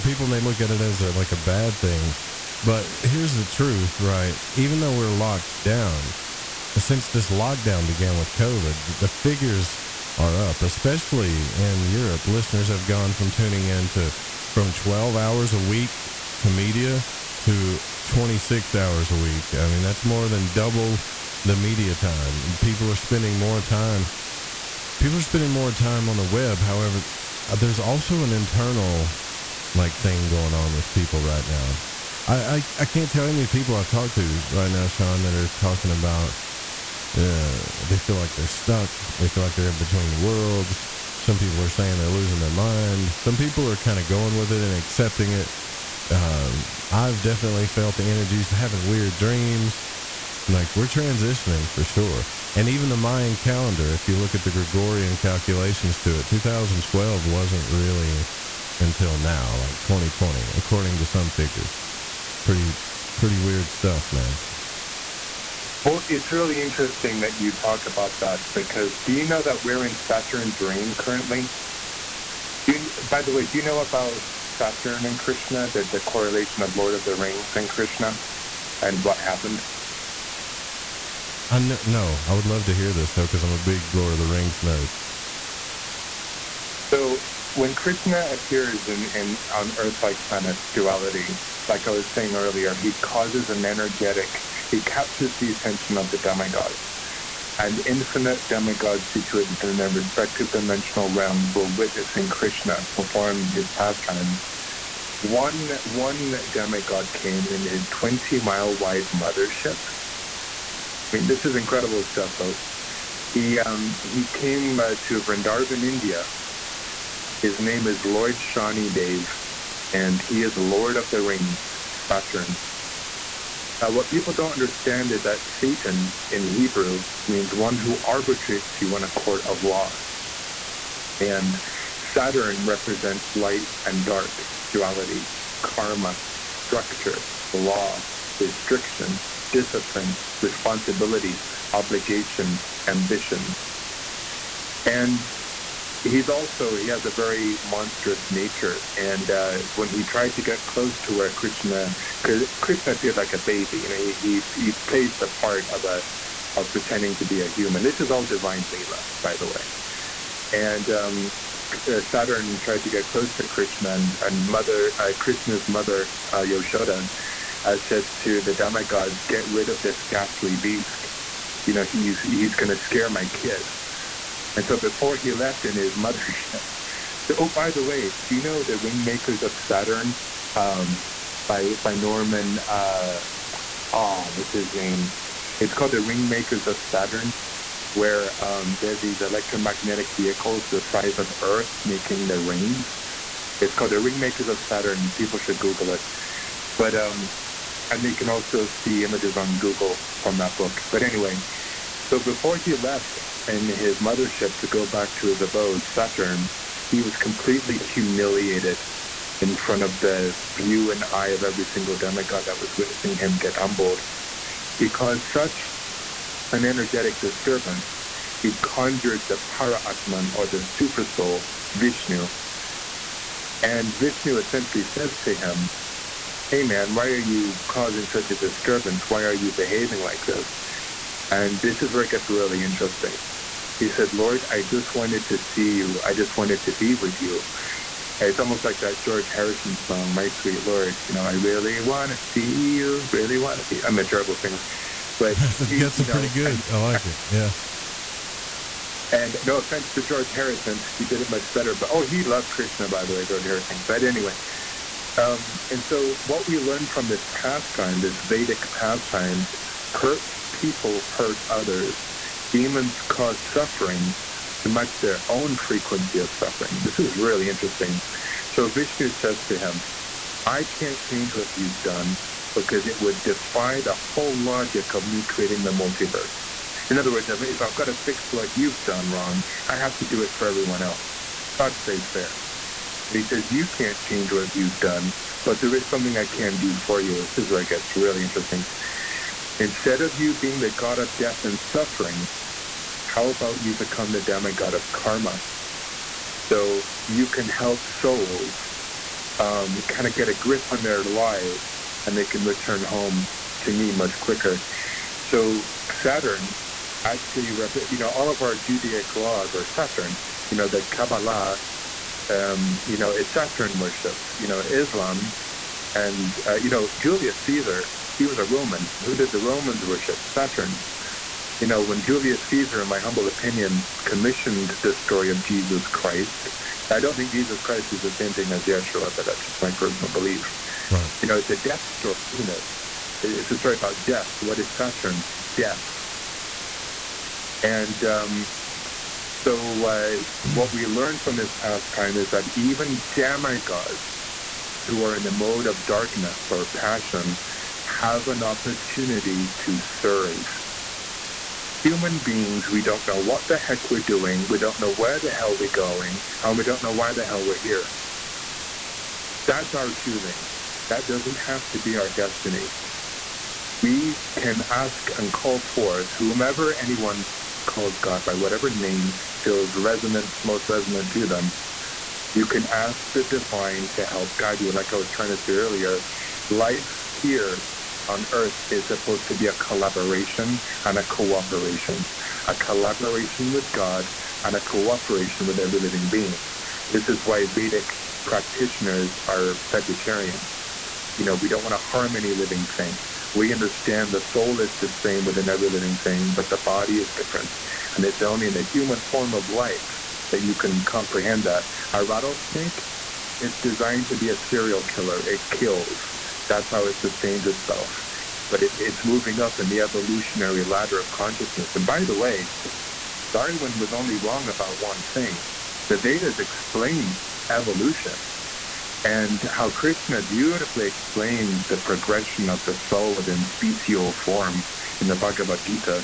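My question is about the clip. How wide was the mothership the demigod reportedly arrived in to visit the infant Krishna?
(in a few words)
20 miles.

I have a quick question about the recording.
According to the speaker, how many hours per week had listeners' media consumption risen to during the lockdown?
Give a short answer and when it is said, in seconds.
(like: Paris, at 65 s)
26 hours, at 18 s.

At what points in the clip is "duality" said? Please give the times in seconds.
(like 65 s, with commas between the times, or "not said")
90 s, 134 s.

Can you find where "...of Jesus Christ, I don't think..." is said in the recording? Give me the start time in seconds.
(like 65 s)
325 s.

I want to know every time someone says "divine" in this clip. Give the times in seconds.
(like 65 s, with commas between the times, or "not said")
158 s, 373 s.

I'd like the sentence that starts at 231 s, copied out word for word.
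And this is where it gets really interesting.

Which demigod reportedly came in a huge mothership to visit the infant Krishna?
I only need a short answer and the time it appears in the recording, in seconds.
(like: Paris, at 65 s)
Lord Shani Dev, at 118 s.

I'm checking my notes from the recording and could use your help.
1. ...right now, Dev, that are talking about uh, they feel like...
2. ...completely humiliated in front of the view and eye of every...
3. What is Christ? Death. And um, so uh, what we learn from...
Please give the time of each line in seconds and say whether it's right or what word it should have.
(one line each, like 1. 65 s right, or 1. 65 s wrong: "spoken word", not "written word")
1. 34 s wrong: "Sean", not "Dev"
2. 207 s right
3. 334 s wrong: "Saturn", not "Christ".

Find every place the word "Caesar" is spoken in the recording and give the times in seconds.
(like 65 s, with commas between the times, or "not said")
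317 s, 322 s.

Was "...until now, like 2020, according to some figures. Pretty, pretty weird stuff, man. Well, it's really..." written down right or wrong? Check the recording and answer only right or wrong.
right.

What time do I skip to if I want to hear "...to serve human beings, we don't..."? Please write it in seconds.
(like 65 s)
349 s.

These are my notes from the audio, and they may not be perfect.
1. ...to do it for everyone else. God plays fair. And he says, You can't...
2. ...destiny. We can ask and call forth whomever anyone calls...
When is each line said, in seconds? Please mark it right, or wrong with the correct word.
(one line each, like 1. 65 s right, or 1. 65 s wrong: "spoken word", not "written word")
1. 279 s right
2. 362 s right.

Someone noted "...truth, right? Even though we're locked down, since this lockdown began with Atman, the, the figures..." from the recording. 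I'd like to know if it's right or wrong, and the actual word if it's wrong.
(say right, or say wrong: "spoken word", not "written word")
wrong: "COVID", not "Atman".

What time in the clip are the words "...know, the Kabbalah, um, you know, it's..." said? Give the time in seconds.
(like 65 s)
310 s.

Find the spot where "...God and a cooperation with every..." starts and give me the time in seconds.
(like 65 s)
383 s.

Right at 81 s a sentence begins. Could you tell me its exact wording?
I kn- no, I would love to hear this though, because I'm a big Lord of the Rings nerd.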